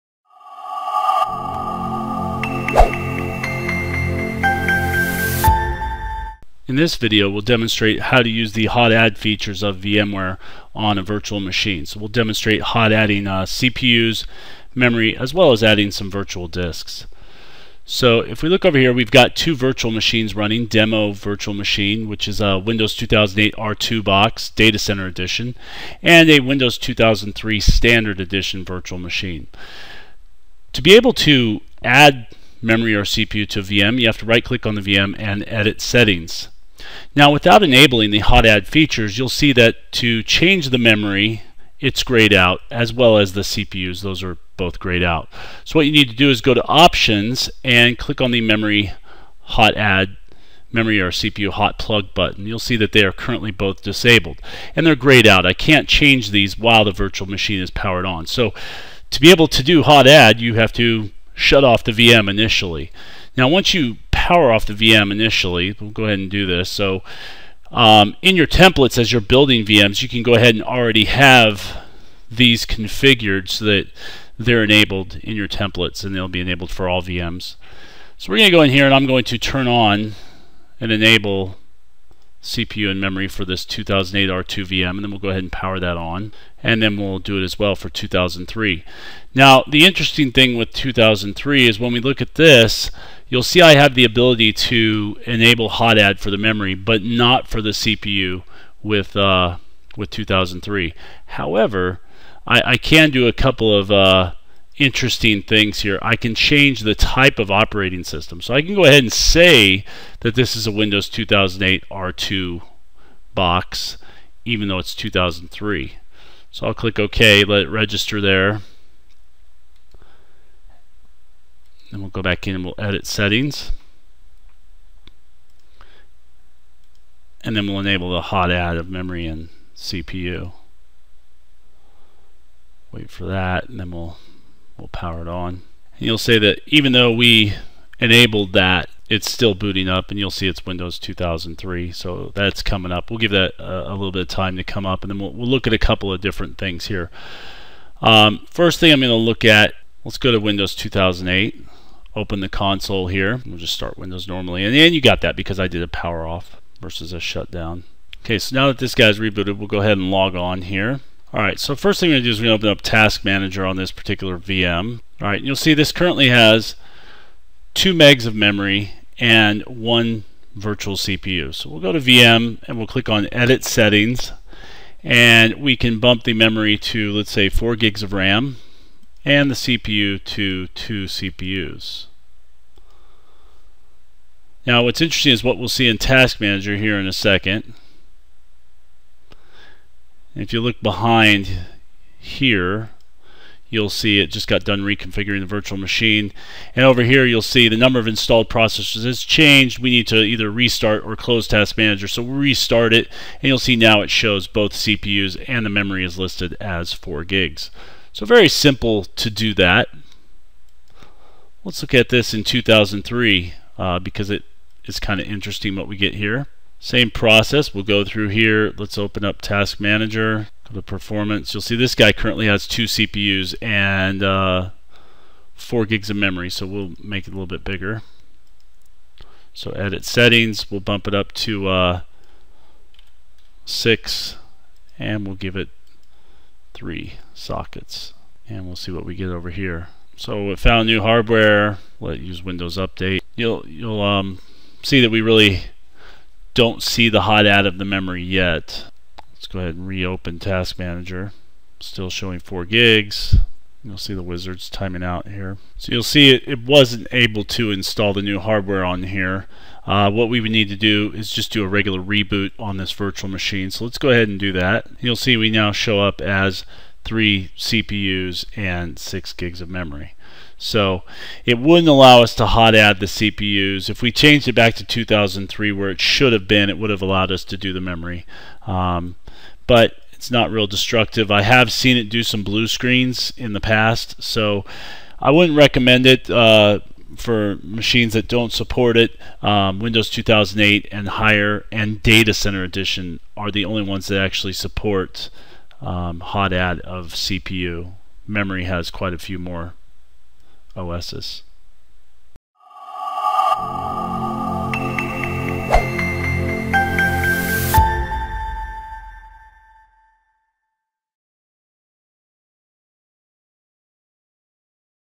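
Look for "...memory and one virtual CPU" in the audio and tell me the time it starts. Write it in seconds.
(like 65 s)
168 s.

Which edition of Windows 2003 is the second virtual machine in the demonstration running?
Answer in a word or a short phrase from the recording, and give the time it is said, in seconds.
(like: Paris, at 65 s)
Standard edition, at 27 s.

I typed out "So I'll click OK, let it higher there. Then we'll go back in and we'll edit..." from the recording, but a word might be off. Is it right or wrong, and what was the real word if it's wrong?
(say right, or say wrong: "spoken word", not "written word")
wrong: "register", not "higher".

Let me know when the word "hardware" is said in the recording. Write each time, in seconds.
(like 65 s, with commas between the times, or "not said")
241 s, 258 s.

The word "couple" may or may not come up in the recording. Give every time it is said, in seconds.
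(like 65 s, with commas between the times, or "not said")
103 s, 145 s.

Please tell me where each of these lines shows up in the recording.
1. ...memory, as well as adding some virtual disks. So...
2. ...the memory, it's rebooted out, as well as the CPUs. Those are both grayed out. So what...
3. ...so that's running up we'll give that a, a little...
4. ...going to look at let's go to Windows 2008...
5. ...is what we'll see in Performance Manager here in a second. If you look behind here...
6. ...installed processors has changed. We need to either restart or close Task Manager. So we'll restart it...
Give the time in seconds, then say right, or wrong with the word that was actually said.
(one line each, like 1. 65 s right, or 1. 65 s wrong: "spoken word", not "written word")
1. 14 s right
2. 40 s wrong: "grayed", not "rebooted"
3. 141 s wrong: "coming", not "running"
4. 149 s right
5. 185 s wrong: "Task", not "Performance"
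6. 198 s right.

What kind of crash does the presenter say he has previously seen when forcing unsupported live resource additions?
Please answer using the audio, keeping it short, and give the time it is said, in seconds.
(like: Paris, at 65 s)
Blue screens, at 282 s.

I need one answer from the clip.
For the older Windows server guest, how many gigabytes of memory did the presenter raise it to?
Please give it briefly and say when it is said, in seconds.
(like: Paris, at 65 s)
6, at 233 s.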